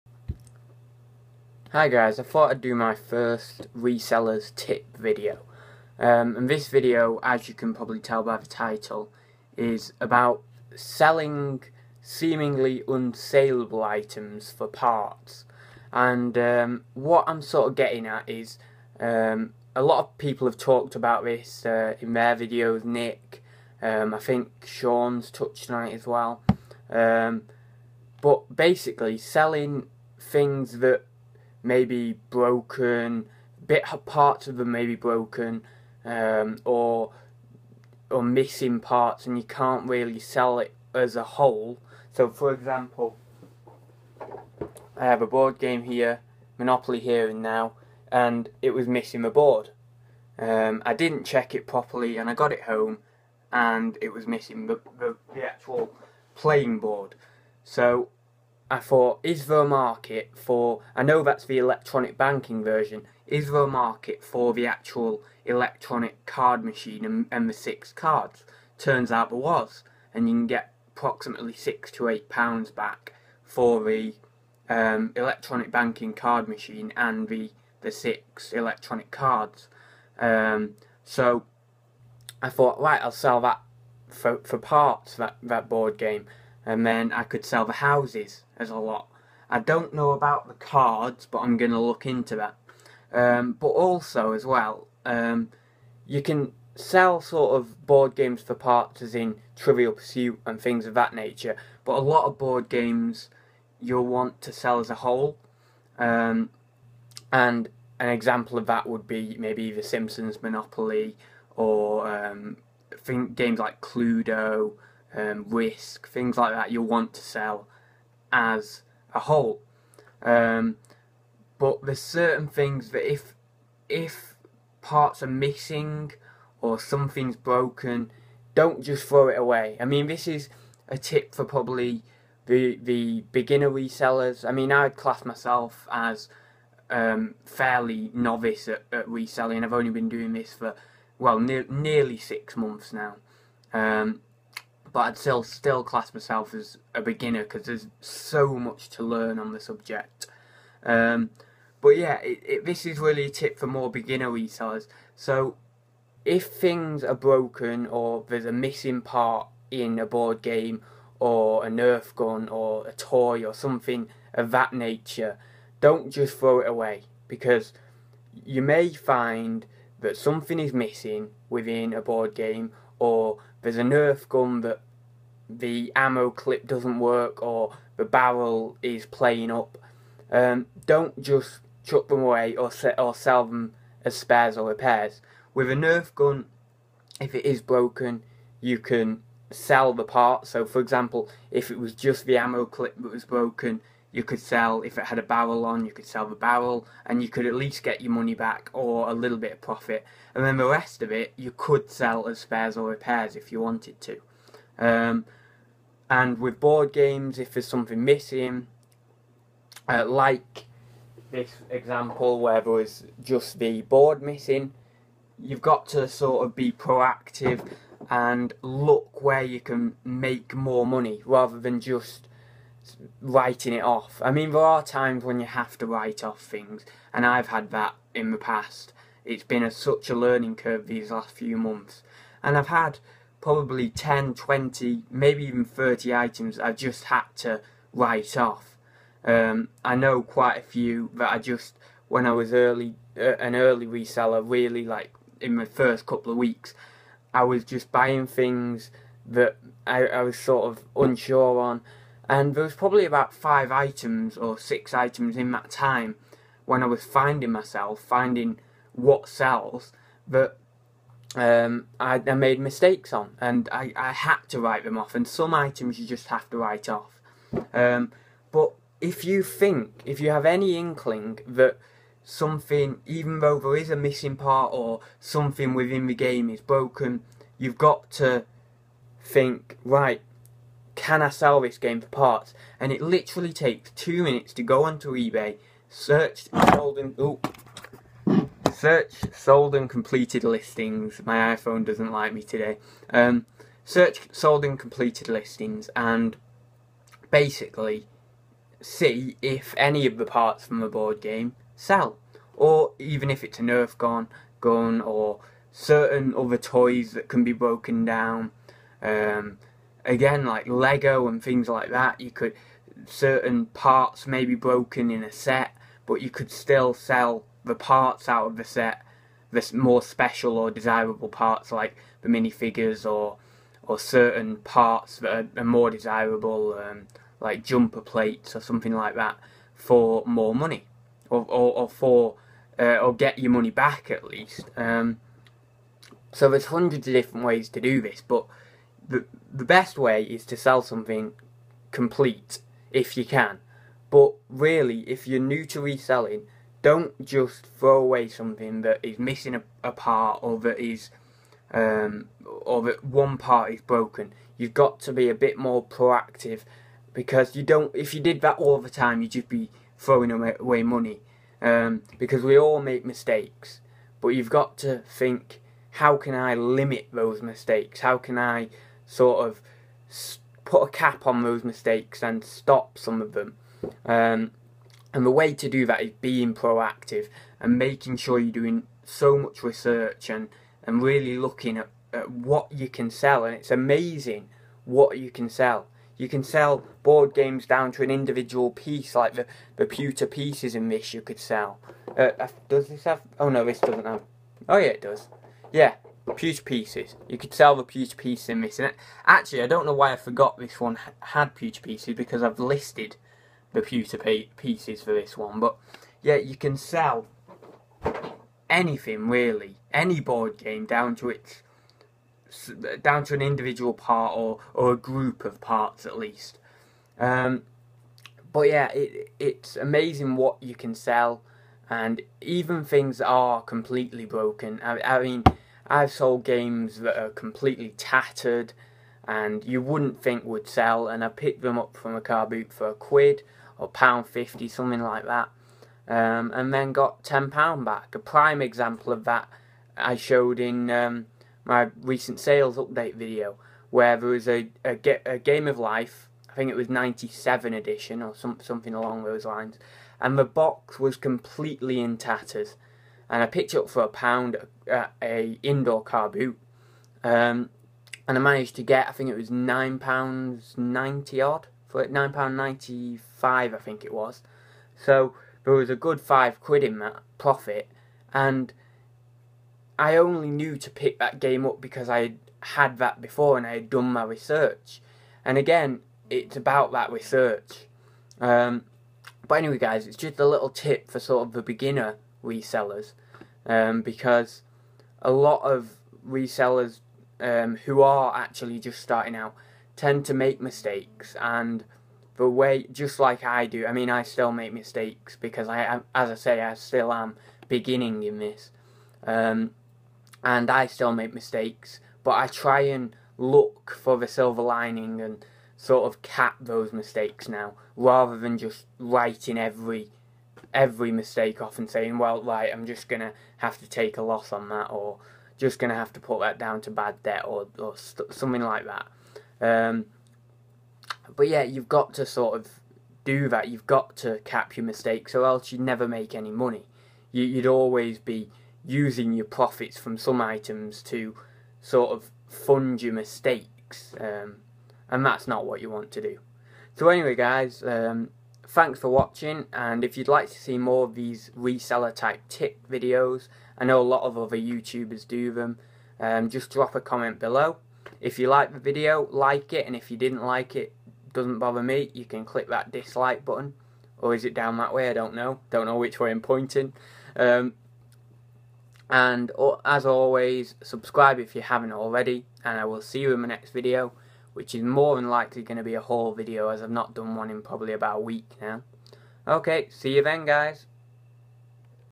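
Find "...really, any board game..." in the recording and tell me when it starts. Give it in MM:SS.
06:49.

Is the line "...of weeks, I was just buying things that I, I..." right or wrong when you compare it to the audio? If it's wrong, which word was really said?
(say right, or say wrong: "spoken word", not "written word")
right.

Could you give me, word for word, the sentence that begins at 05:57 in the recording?
If you did that all the time, you'd just be throwing away money um, because we all make mistakes.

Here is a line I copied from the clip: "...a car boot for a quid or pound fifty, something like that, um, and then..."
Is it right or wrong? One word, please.
right.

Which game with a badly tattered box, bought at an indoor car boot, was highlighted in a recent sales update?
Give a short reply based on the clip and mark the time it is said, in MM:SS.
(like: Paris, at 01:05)
Game of Life, at 07:25.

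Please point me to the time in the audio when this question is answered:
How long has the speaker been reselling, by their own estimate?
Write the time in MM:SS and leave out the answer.
02:21.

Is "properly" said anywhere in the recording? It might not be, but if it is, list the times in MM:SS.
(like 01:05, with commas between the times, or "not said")
00:51.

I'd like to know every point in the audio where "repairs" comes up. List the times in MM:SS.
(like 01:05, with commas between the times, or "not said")
03:04, 03:22.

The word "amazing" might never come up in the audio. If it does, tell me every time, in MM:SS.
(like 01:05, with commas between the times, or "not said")
06:23, 06:59.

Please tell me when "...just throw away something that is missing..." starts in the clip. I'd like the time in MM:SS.
05:47.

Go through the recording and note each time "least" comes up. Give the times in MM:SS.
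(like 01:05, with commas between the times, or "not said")
03:17, 05:34, 06:56.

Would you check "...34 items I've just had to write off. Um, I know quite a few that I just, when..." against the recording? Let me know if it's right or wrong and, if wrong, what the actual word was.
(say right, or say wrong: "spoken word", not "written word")
wrong: "30", not "34".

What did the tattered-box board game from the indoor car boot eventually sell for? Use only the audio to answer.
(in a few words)
£9.95.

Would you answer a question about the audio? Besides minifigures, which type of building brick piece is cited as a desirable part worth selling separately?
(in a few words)
jumper plates.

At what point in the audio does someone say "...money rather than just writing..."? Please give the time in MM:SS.
03:40.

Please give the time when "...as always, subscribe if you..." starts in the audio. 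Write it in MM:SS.
09:19.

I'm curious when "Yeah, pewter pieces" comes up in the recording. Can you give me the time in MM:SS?
06:35.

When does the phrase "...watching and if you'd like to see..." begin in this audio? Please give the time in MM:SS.
08:59.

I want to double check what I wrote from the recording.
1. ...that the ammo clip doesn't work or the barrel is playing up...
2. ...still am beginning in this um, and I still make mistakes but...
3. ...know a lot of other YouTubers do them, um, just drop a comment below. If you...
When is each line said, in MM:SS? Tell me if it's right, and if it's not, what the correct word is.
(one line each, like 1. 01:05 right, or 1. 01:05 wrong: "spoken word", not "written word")
1. 02:54 right
2. 08:16 right
3. 09:03 right.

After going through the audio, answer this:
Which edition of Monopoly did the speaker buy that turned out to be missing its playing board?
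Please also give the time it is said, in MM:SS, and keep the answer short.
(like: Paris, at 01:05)
Here and Now, at 00:46.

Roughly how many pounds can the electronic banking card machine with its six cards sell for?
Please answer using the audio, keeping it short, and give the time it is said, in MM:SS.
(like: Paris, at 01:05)
6 to 8 pounds, at 01:11.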